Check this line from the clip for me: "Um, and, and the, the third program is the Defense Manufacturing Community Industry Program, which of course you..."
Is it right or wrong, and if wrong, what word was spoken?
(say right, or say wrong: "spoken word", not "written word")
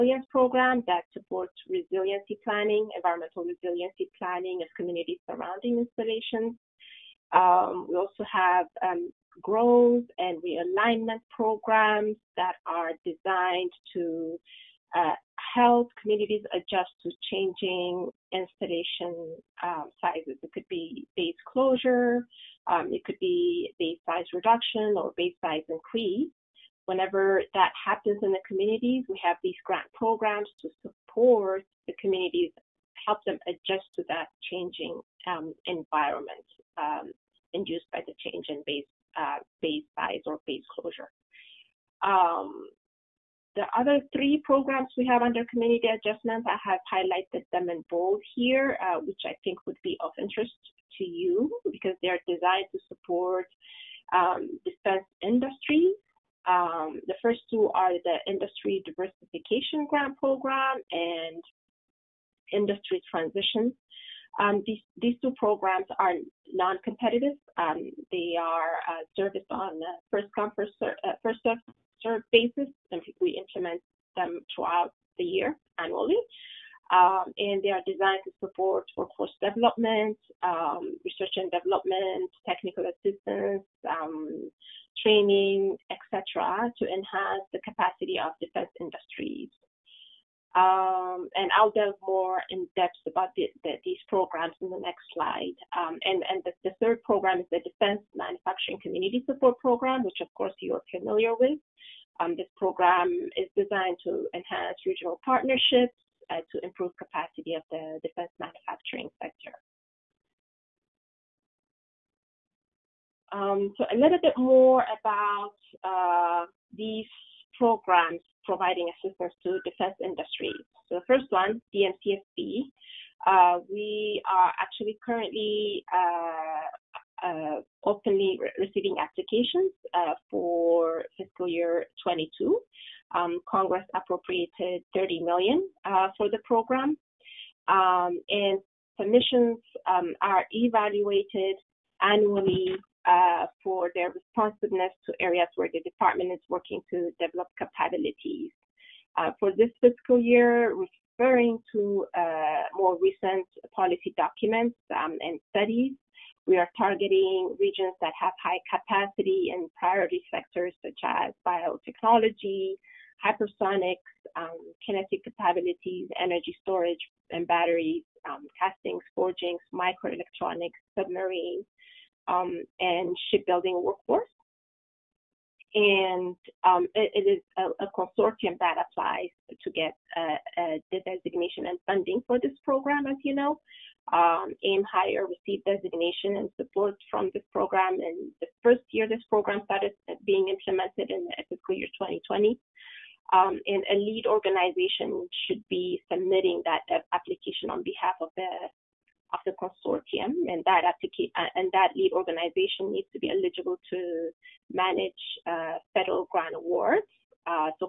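wrong: "Support", not "Industry".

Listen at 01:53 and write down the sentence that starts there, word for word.
Um, so a little bit more about uh, these programs providing assistance to defense industry.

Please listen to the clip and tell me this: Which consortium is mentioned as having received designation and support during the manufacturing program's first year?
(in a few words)
AIM Higher.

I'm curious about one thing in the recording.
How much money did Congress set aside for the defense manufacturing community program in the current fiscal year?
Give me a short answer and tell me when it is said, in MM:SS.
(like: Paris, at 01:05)
$30 million, at 02:14.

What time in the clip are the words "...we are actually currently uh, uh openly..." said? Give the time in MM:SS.
02:03.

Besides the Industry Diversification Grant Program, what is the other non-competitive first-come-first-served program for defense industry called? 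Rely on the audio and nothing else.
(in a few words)
Industry Transition.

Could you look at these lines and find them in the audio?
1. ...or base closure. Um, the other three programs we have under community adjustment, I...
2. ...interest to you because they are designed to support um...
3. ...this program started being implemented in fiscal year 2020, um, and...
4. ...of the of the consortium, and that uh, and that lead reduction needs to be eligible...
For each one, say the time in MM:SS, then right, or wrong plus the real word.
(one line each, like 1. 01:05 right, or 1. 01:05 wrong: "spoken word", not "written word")
1. 00:40 right
2. 00:50 right
3. 03:09 right
4. 03:18 wrong: "organization", not "reduction".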